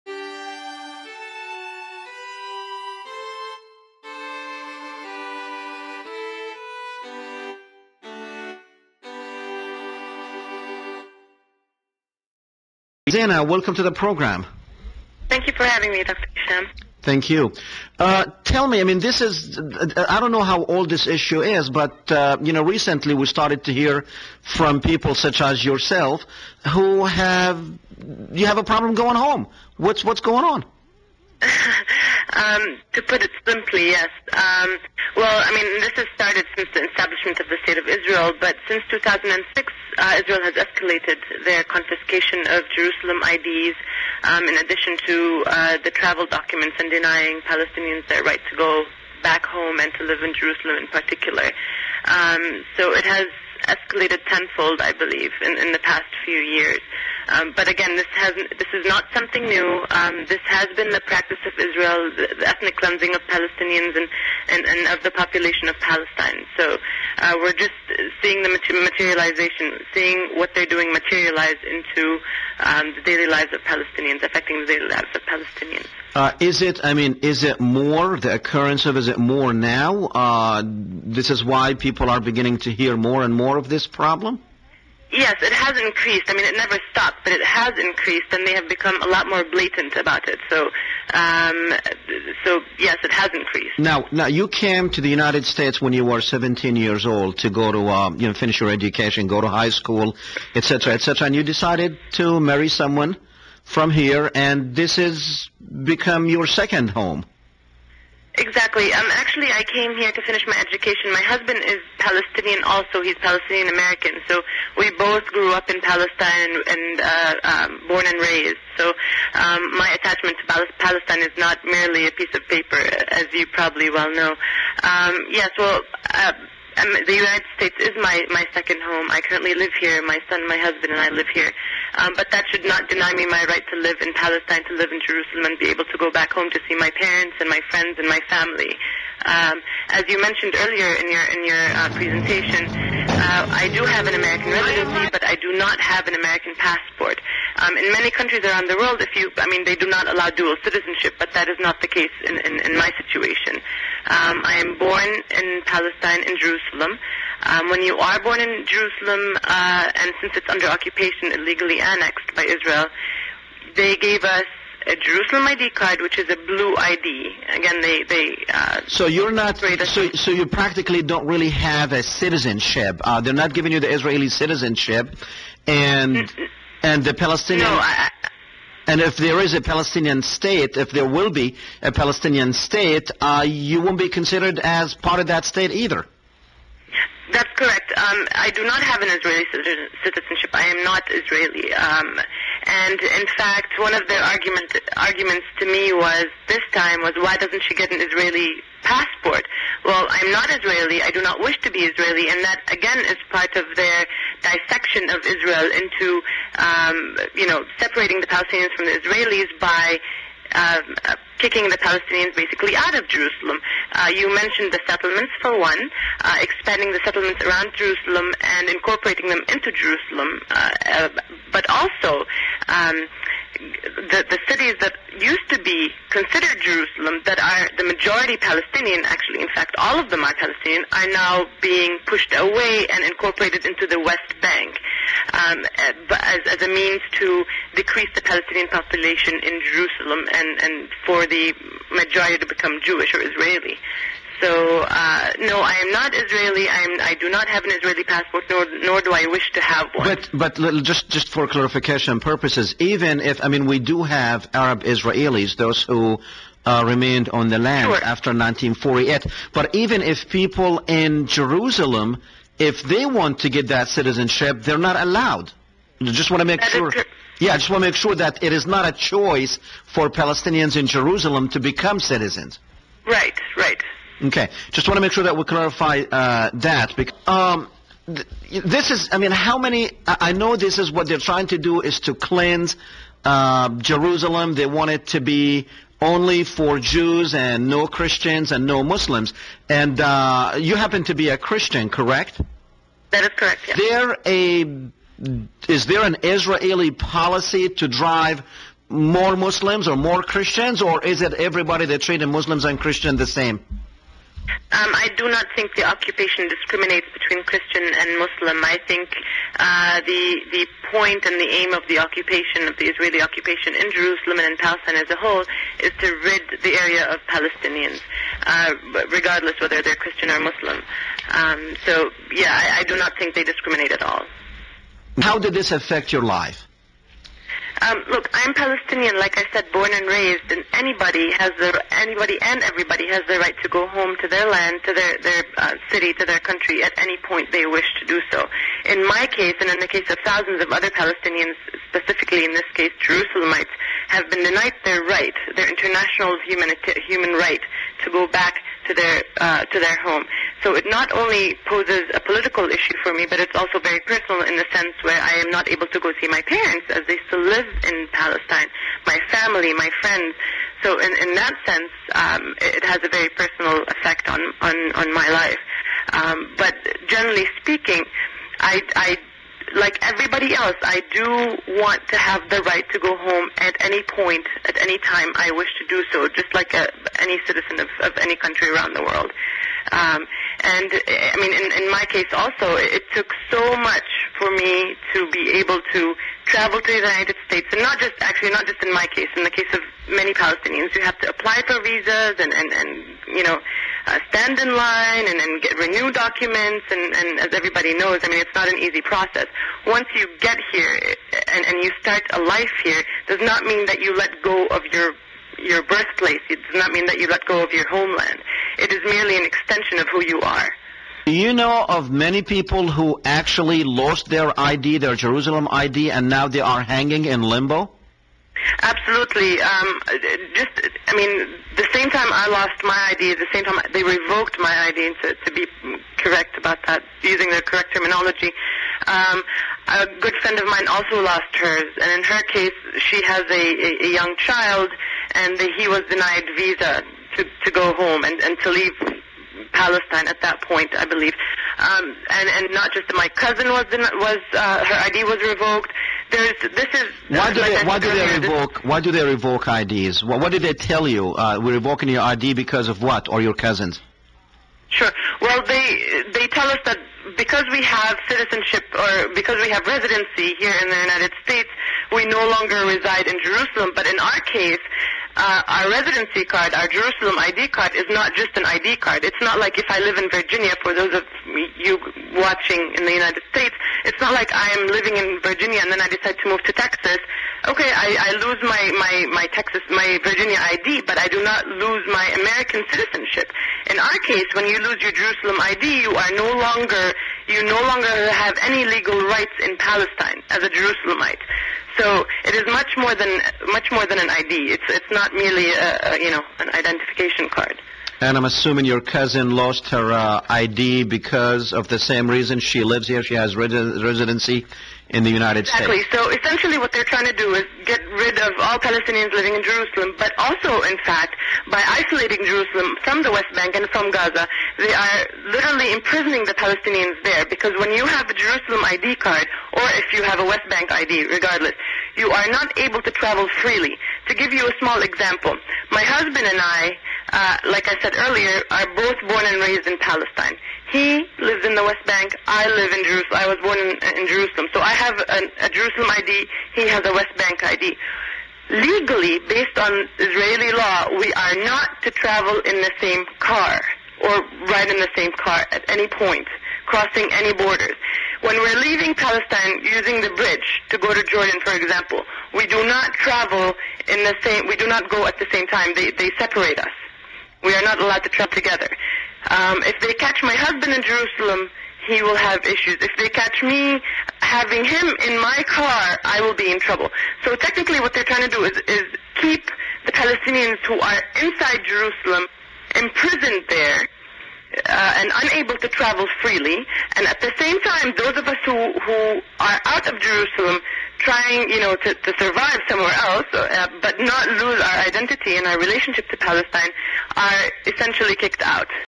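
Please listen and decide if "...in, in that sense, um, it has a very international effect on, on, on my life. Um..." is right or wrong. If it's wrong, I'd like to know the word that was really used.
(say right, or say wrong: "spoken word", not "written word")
wrong: "personal", not "international".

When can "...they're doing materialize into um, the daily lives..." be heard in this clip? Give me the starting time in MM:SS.
01:10.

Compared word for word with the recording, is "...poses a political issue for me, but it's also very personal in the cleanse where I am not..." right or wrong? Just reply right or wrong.
wrong.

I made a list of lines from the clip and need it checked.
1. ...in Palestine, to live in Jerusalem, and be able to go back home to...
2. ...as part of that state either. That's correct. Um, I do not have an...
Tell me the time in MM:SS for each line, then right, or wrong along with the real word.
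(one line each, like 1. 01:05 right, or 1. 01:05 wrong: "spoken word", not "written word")
1. 02:14 right
2. 03:04 right.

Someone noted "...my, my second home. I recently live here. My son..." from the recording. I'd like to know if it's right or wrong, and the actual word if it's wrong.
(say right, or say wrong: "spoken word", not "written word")
wrong: "currently", not "recently".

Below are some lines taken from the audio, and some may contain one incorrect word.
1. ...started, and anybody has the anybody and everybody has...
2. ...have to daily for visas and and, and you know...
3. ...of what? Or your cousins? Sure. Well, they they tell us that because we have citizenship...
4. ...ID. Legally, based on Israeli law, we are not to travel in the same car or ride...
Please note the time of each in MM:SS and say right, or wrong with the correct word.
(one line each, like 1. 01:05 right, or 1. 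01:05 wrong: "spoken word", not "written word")
1. 05:30 wrong: "raised", not "started"
2. 06:31 wrong: "apply", not "daily"
3. 07:32 right
4. 08:57 right.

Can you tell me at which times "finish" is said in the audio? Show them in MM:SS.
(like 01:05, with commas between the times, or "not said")
01:38, 01:50.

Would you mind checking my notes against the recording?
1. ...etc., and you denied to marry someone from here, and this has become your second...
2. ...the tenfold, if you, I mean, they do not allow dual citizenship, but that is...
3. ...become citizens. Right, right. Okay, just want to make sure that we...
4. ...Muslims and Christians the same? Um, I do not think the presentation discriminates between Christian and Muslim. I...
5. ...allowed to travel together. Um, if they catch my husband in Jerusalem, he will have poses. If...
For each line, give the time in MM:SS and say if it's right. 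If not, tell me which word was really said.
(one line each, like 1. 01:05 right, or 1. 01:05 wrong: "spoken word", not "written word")
1. 01:40 wrong: "decided", not "denied"
2. 02:28 wrong: "world", not "tenfold"
3. 04:31 right
4. 05:02 wrong: "occupation", not "presentation"
5. 09:18 wrong: "issues", not "poses".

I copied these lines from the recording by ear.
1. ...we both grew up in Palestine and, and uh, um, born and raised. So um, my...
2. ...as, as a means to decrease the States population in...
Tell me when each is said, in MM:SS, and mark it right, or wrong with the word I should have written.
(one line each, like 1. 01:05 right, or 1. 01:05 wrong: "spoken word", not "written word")
1. 01:54 right
2. 03:56 wrong: "Palestinian", not "States".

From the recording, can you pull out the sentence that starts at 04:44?
They want it to be only for Jews and no Christians and no Muslims.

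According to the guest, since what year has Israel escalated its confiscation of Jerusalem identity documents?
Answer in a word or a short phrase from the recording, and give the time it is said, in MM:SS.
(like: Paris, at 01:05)
2006, at 00:38.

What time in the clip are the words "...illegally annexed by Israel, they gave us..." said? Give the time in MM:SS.
02:41.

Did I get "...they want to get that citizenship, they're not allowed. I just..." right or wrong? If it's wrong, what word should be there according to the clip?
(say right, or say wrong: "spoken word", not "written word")
right.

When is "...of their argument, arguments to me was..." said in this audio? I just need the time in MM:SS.
03:13.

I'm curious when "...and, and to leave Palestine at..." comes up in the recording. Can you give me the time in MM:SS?
07:18.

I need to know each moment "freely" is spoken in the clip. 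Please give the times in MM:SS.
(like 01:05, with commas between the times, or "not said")
08:43, 09:36.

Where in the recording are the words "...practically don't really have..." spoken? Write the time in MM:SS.
02:50.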